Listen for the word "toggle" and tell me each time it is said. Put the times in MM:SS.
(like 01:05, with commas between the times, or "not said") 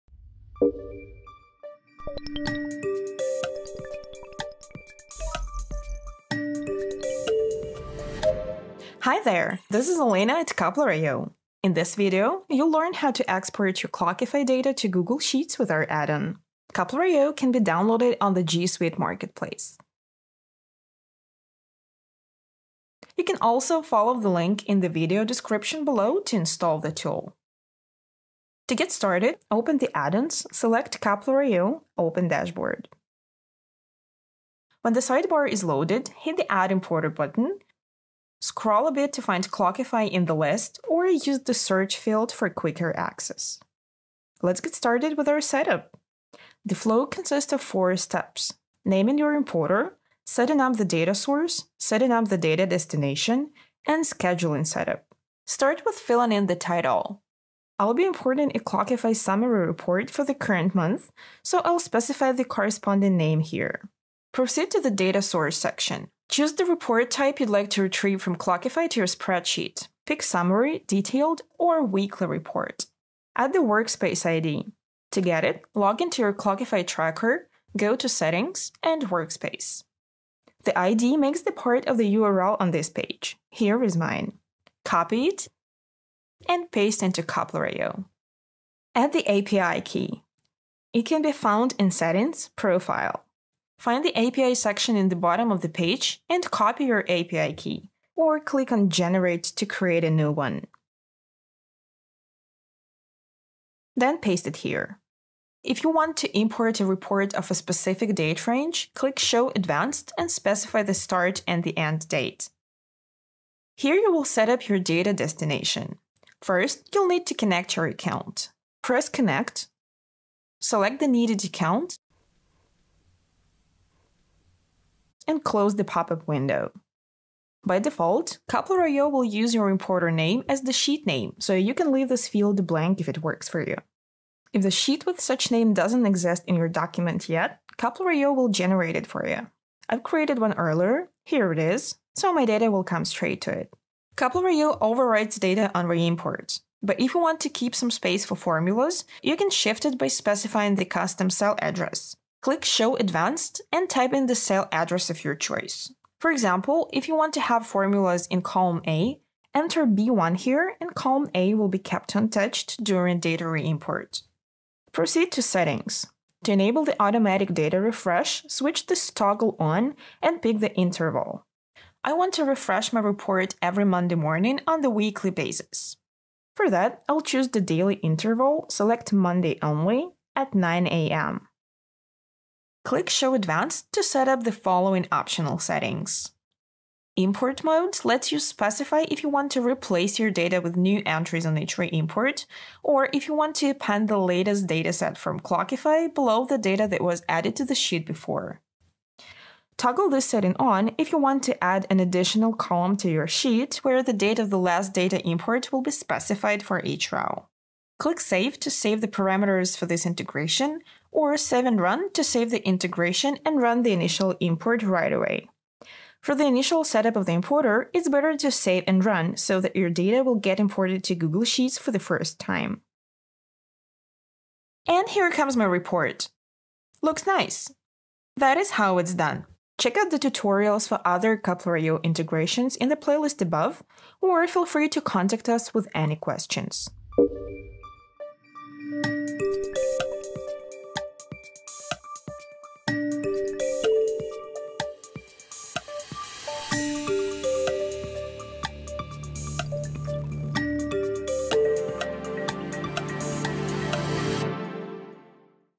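02:49, 03:19.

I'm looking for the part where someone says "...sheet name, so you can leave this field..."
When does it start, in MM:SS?
02:10.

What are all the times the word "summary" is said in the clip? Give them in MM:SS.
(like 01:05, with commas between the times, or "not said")
00:59, 01:10.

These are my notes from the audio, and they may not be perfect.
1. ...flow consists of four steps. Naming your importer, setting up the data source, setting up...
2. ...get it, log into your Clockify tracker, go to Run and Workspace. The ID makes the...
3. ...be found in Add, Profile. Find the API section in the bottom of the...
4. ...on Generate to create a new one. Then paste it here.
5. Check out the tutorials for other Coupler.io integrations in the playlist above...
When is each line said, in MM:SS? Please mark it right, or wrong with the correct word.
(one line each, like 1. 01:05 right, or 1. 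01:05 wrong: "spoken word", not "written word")
1. 00:46 right
2. 01:15 wrong: "Settings", not "Run"
3. 01:31 wrong: "Settings", not "Add"
4. 01:38 right
5. 03:49 right.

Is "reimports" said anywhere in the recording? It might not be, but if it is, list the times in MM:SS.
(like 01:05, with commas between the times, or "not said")
02:25, 02:43.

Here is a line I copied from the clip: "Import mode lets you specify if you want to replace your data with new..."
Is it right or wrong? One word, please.
right.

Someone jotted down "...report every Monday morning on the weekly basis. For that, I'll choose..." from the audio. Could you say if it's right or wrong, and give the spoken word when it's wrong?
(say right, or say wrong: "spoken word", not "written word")
right.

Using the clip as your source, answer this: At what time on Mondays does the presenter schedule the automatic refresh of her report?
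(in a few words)
9 a.m.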